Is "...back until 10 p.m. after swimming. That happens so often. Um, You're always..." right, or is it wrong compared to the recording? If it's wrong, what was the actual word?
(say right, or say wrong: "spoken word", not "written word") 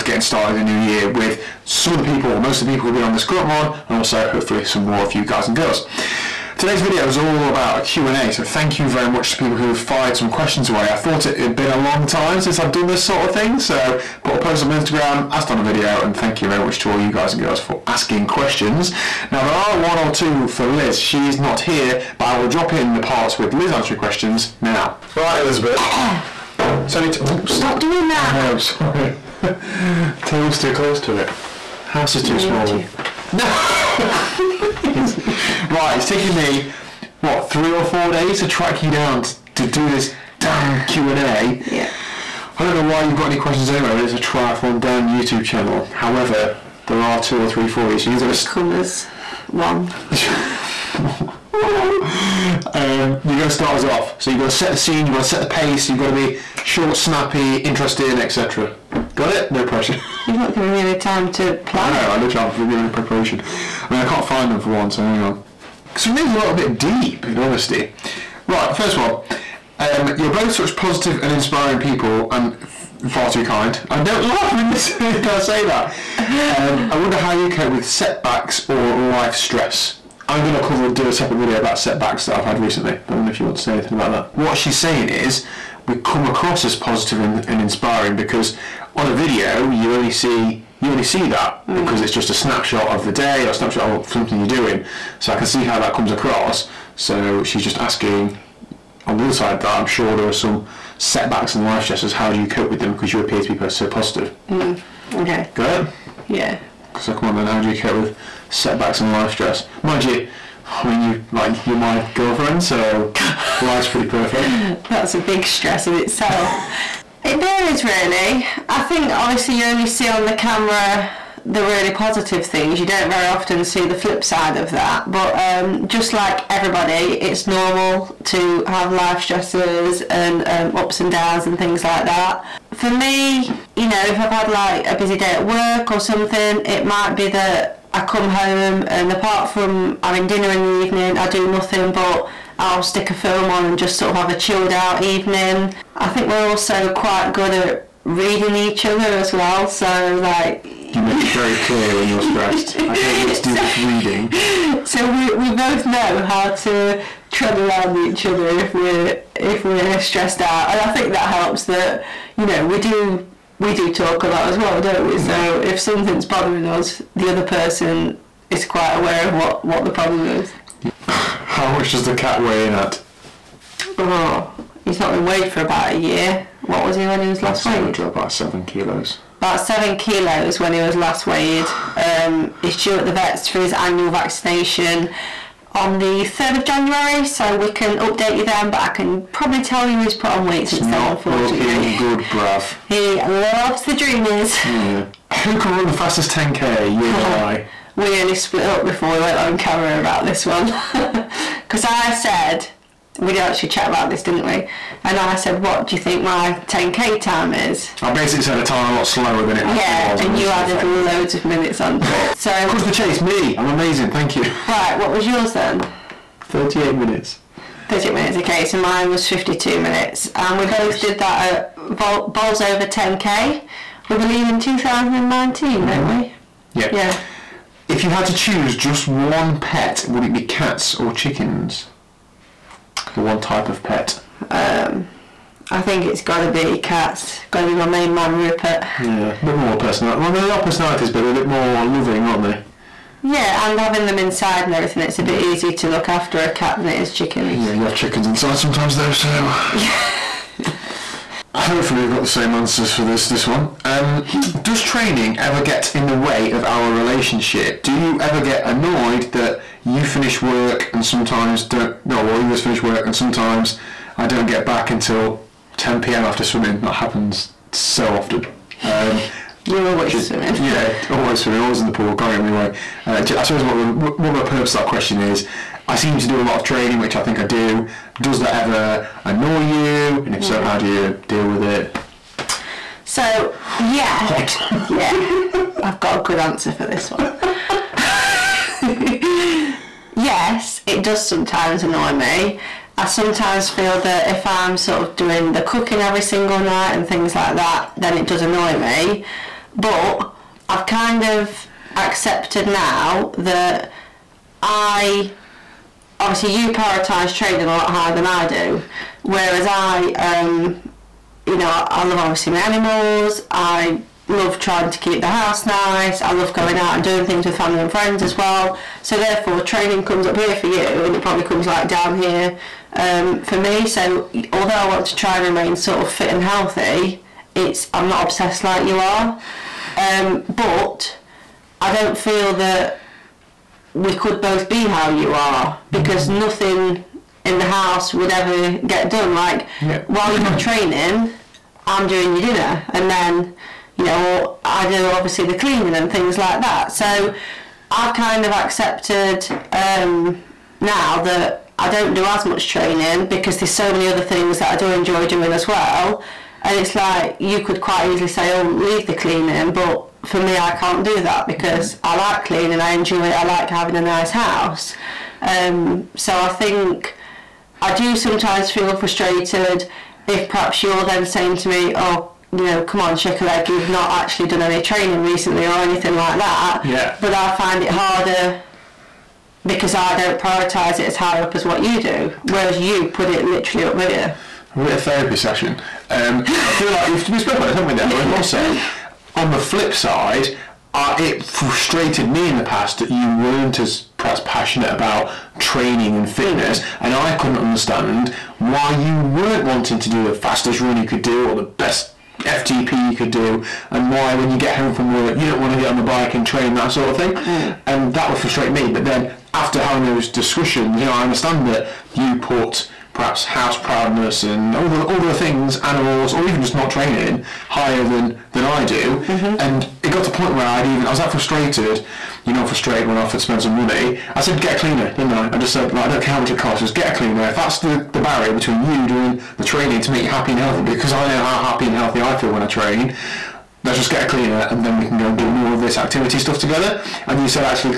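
right.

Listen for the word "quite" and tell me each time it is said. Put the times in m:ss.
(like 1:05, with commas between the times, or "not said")
2:26, 2:48, 5:57.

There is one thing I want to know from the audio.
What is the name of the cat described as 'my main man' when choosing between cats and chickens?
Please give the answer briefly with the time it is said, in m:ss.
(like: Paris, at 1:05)
Rupert, at 3:58.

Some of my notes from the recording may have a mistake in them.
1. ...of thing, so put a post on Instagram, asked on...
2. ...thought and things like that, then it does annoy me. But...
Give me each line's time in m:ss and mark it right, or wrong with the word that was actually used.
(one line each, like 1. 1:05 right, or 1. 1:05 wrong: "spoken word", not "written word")
1. 0:13 right
2. 4:56 wrong: "night", not "thought".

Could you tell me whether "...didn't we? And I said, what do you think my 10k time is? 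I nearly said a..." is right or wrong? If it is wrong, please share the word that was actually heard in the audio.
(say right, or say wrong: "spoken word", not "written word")
wrong: "basically", not "nearly".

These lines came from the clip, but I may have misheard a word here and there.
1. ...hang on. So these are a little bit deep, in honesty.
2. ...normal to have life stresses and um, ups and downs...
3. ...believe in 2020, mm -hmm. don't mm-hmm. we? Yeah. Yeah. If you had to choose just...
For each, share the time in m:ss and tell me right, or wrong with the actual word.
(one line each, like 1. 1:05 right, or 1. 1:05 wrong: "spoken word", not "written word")
1. 1:05 right
2. 2:07 right
3. 3:44 wrong: "2019", not "2020".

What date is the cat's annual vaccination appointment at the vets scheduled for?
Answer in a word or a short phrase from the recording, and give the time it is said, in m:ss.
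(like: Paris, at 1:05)
3rd of January, at 3:06.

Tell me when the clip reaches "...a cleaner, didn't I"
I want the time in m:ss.
7:04.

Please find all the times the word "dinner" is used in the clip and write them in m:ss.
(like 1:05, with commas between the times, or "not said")
2:20, 5:42.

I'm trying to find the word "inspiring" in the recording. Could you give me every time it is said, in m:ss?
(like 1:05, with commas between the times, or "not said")
1:11, 1:27.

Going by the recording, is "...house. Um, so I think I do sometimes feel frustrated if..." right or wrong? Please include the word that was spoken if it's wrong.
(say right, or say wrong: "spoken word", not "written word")
right.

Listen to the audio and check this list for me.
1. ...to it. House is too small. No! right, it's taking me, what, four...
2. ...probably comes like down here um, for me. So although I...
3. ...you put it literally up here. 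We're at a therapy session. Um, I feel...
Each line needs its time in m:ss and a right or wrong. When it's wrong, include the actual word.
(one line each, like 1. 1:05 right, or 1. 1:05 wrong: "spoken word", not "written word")
1. 0:31 wrong: "three", not "four"
2. 5:21 right
3. 6:22 right.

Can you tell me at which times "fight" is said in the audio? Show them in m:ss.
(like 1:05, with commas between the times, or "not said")
not said.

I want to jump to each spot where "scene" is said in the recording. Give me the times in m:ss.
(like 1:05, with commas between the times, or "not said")
0:54.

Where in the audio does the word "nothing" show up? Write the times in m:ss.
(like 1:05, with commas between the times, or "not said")
2:21, 5:36.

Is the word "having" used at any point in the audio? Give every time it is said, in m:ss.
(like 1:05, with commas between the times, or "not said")
2:20, 4:03, 6:03, 6:49.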